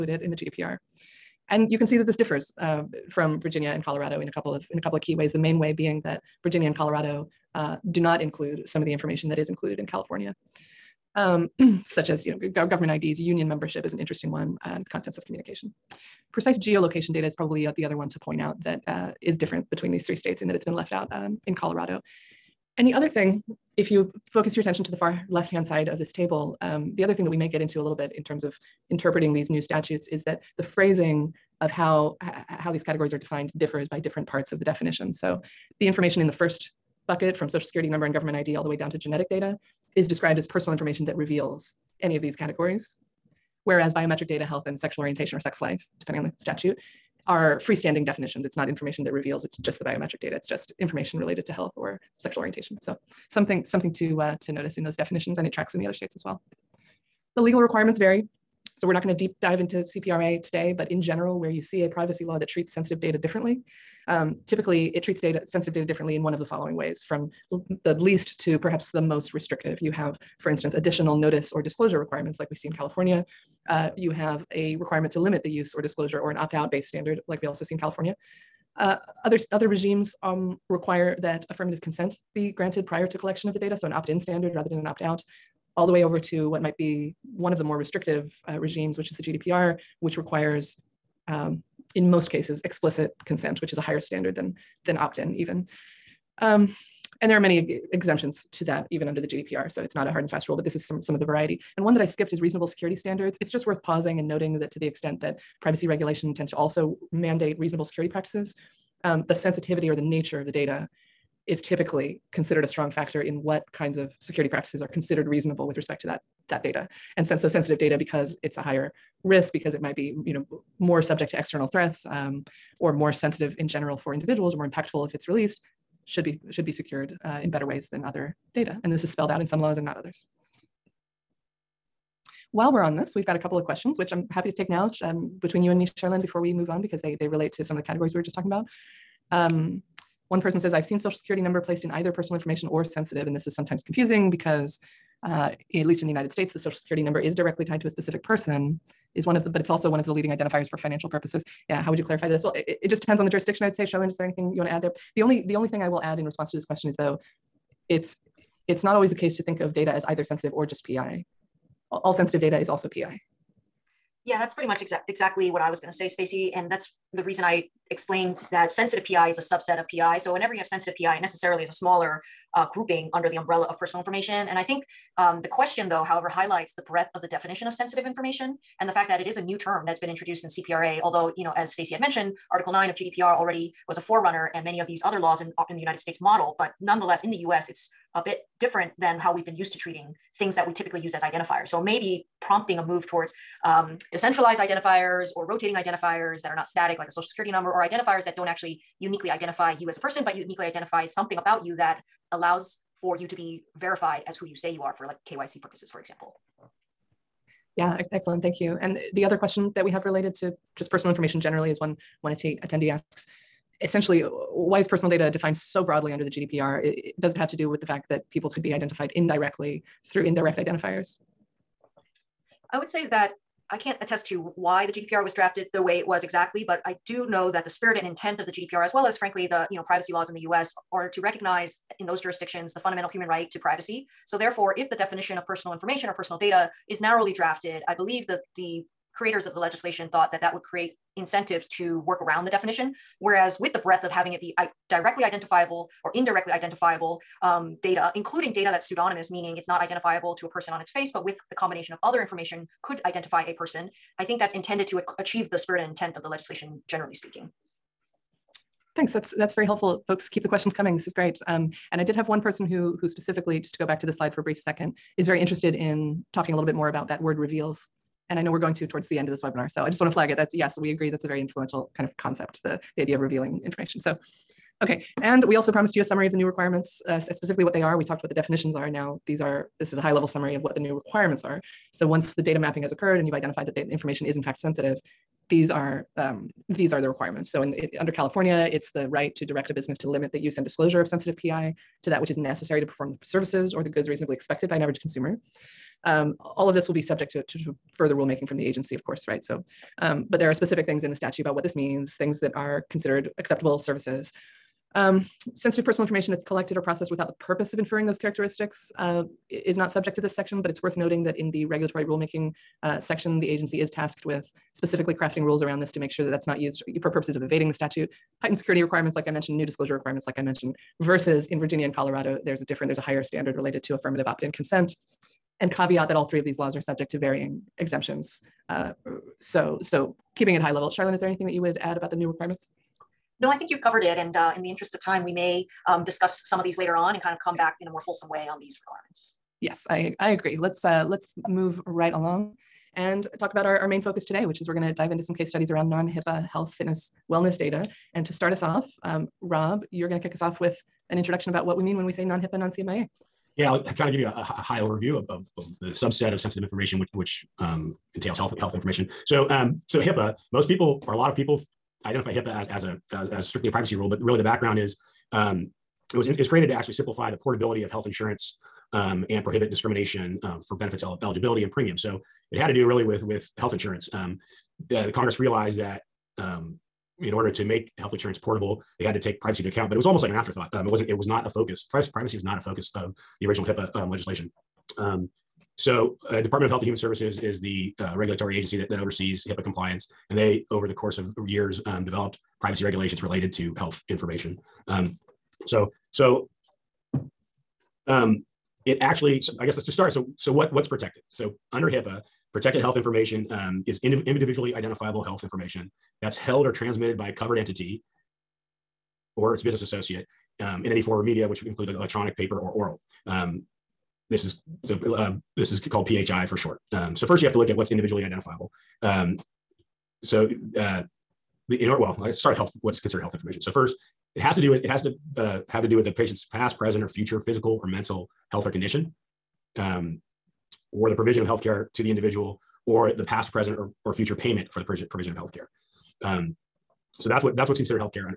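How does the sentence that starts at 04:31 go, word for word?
That's a very influential kind of concept.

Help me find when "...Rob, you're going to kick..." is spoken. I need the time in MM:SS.
05:49.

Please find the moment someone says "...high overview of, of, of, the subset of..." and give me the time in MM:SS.
05:54.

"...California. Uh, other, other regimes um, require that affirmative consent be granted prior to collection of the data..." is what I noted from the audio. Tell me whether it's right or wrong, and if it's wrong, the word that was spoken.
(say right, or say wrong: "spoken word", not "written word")
right.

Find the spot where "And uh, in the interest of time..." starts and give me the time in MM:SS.
05:34.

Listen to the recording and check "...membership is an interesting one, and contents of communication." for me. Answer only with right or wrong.
right.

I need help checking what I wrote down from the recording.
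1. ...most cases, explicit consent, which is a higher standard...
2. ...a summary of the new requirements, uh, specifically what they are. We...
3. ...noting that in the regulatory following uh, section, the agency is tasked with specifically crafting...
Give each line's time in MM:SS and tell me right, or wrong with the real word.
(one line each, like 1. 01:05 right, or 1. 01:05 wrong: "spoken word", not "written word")
1. 01:32 right
2. 04:35 right
3. 05:10 wrong: "rulemaking", not "following".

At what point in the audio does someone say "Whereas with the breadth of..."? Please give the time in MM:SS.
04:03.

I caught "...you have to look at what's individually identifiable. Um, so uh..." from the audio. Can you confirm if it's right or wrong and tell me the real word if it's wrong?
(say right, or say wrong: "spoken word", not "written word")
right.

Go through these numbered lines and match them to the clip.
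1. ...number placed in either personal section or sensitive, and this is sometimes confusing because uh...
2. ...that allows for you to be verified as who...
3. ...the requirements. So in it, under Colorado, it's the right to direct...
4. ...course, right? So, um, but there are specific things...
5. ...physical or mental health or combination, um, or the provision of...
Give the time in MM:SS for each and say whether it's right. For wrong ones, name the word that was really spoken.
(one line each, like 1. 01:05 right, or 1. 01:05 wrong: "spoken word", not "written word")
1. 02:21 wrong: "information", not "section"
2. 03:21 right
3. 04:47 wrong: "California", not "Colorado"
4. 04:59 right
5. 07:07 wrong: "condition", not "combination".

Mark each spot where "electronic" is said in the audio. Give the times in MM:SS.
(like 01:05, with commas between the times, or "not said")
06:51.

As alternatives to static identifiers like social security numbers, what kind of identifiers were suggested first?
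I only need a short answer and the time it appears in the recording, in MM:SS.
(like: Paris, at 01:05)
decentralized identifiers, at 03:14.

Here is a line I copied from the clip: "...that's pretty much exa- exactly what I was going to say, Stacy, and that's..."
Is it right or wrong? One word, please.
right.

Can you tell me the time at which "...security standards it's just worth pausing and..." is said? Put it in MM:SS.
01:42.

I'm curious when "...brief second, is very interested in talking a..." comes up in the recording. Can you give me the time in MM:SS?
04:24.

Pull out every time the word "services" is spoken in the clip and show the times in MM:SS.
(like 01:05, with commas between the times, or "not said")
04:53, 05:03, 06:26.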